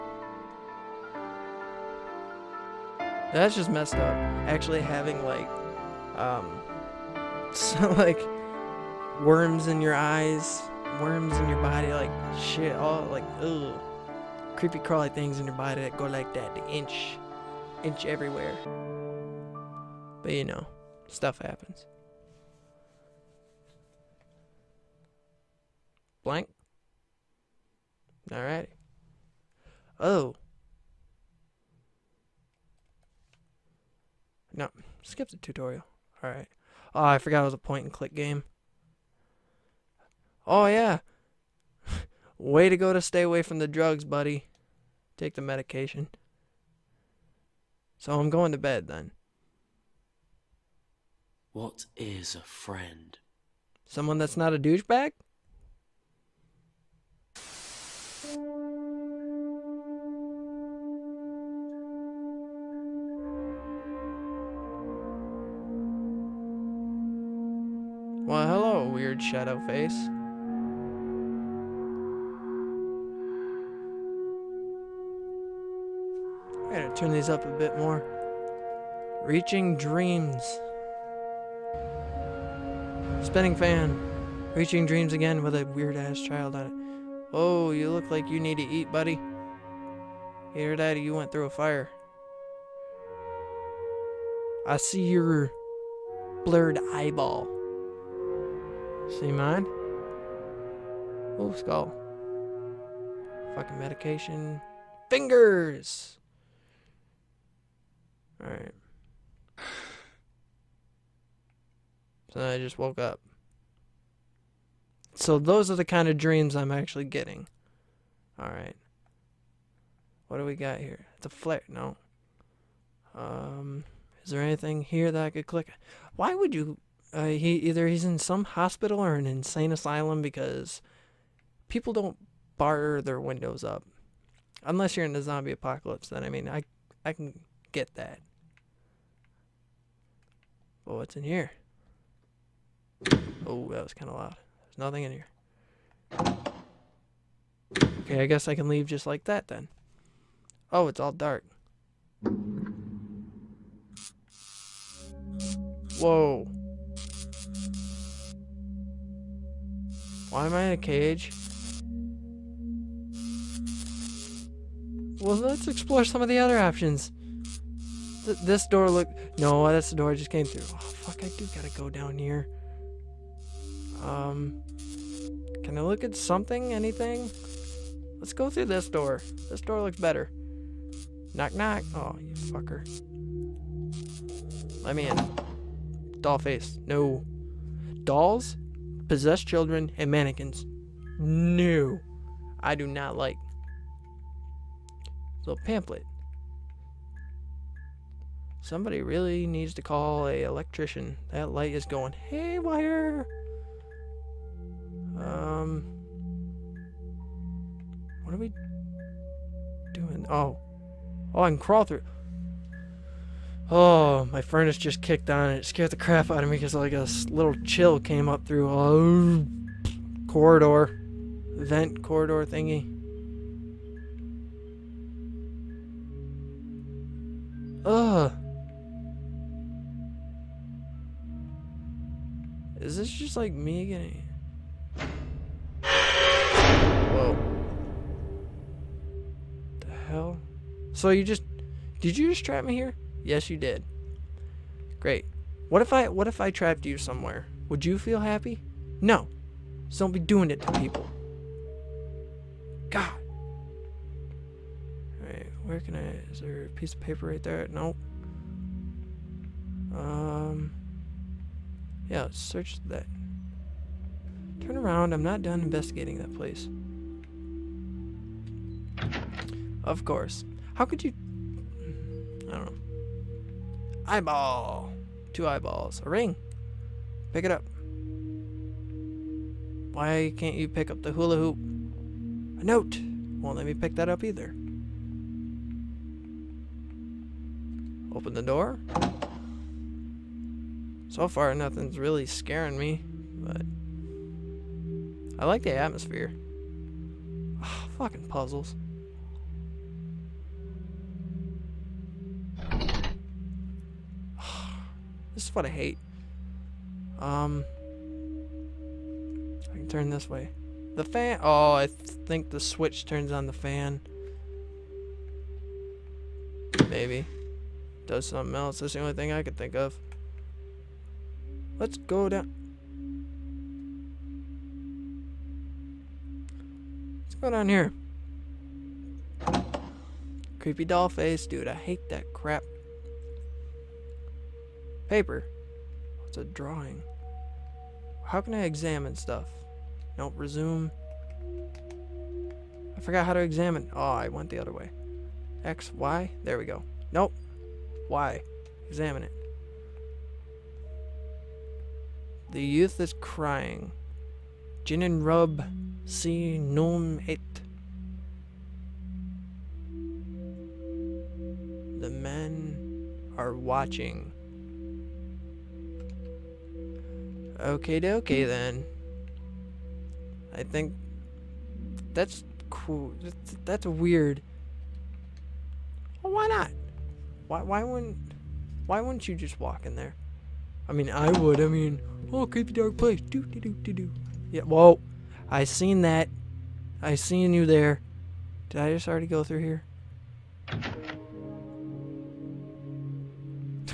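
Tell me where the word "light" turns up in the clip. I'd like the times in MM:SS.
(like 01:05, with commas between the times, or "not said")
03:21.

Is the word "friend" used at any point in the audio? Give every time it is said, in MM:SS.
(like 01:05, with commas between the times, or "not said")
00:52.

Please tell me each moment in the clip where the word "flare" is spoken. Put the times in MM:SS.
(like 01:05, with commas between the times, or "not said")
02:01.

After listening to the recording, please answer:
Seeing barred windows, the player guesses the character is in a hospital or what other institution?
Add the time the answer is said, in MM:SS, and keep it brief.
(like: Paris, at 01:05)
insane asylum, at 02:09.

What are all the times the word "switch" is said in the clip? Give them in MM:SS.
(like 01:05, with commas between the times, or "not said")
05:12.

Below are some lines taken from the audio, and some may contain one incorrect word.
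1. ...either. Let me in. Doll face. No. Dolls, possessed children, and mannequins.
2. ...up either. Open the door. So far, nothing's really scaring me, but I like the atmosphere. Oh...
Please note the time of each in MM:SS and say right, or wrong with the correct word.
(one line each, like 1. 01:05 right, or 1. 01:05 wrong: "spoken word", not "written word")
1. 03:02 wrong: "fucker", not "either"
2. 04:44 right.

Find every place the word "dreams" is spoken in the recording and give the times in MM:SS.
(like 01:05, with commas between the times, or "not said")
01:19, 01:24, 01:56.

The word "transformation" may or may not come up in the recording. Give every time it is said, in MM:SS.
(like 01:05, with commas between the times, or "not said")
not said.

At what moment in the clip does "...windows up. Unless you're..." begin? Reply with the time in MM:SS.
02:13.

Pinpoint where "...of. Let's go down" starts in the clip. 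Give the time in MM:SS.
05:19.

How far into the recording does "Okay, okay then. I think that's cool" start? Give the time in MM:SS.
06:07.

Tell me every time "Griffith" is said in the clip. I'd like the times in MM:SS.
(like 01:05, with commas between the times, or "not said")
not said.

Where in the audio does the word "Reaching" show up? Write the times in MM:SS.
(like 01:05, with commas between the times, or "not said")
01:19, 01:24.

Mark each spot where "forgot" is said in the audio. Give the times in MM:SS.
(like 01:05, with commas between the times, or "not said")
00:37, 05:42.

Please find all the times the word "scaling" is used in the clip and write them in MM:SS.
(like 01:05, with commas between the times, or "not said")
not said.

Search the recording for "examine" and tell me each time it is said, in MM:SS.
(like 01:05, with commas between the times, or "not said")
05:38, 05:43, 05:48.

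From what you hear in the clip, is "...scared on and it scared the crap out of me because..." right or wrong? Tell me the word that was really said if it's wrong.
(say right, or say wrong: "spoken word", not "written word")
wrong: "kicked", not "scared".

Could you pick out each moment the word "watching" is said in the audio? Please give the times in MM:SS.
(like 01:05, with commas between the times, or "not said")
06:03.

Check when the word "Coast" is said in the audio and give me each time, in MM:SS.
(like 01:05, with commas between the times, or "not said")
not said.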